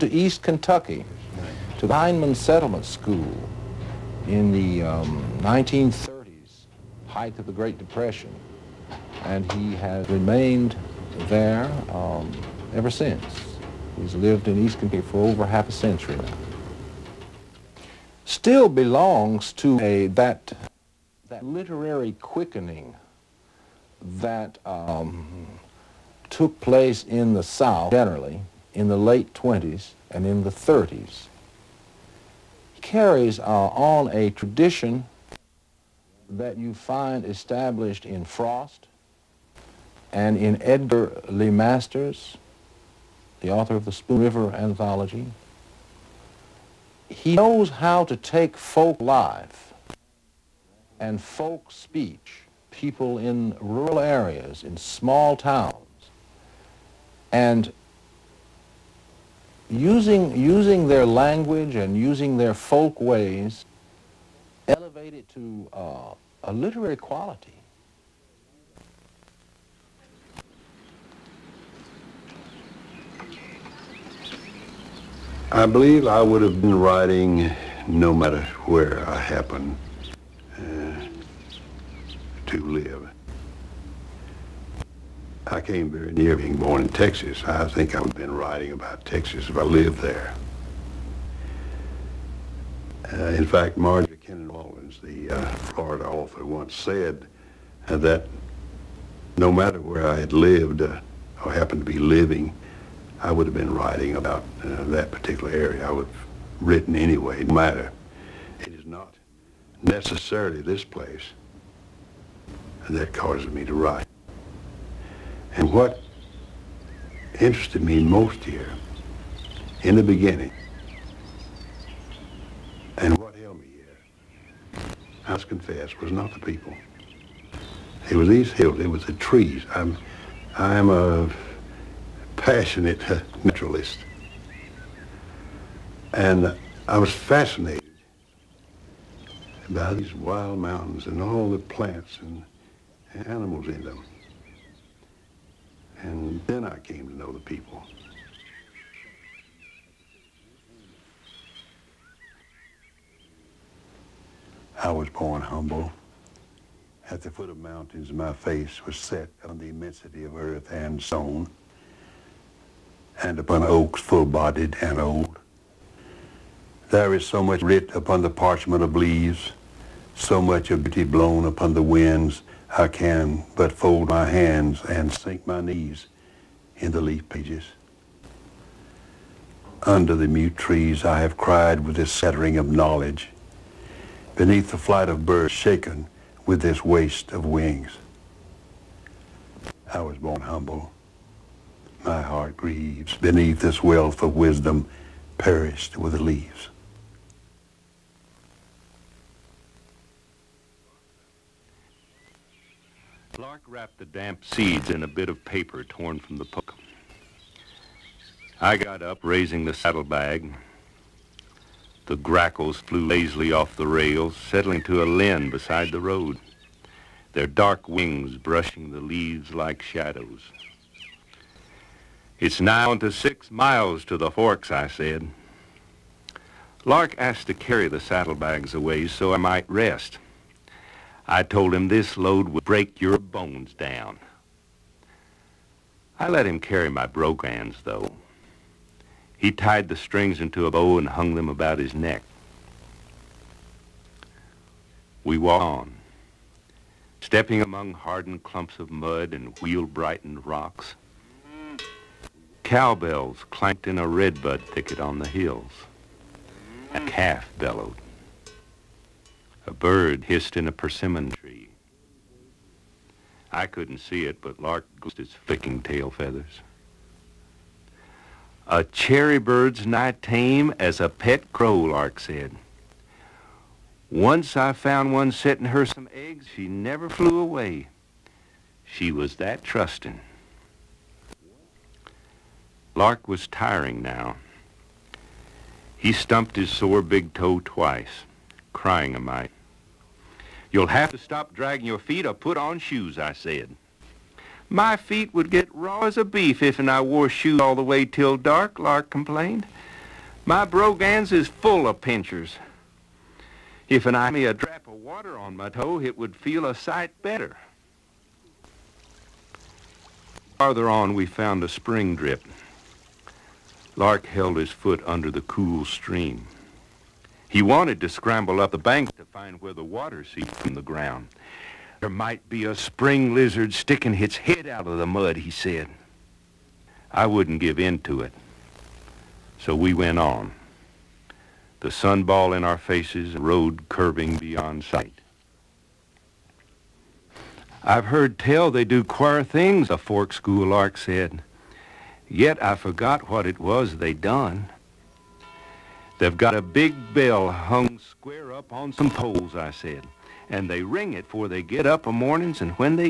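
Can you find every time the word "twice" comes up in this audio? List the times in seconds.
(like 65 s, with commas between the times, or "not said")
287 s.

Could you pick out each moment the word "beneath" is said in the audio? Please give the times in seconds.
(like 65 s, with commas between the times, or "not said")
184 s, 193 s.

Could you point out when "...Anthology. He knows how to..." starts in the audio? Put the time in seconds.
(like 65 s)
44 s.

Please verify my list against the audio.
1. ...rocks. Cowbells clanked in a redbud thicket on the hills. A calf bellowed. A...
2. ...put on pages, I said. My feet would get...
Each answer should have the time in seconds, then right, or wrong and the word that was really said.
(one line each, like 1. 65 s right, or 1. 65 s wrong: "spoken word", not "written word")
1. 250 s right
2. 292 s wrong: "shoes", not "pages".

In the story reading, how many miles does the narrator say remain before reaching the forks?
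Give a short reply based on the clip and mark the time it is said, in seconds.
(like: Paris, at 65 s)
6, at 223 s.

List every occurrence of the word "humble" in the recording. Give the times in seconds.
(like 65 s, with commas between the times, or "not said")
155 s, 190 s.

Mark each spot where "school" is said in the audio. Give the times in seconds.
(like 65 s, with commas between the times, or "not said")
2 s, 340 s.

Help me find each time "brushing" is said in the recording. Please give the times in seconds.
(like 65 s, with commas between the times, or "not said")
218 s.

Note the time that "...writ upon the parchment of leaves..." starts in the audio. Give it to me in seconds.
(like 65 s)
167 s.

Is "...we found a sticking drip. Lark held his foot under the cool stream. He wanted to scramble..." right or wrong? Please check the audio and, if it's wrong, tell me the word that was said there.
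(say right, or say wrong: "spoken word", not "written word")
wrong: "spring", not "sticking".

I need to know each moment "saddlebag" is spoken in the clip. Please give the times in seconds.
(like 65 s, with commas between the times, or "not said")
209 s, 228 s.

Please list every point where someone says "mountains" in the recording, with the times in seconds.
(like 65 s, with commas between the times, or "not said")
140 s, 157 s.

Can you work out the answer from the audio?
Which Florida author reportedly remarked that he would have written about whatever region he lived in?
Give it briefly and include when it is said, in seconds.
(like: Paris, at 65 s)
Marjorie Kinnan Rawlings, at 93 s.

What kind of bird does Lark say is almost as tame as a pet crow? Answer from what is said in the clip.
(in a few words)
Cherry bird.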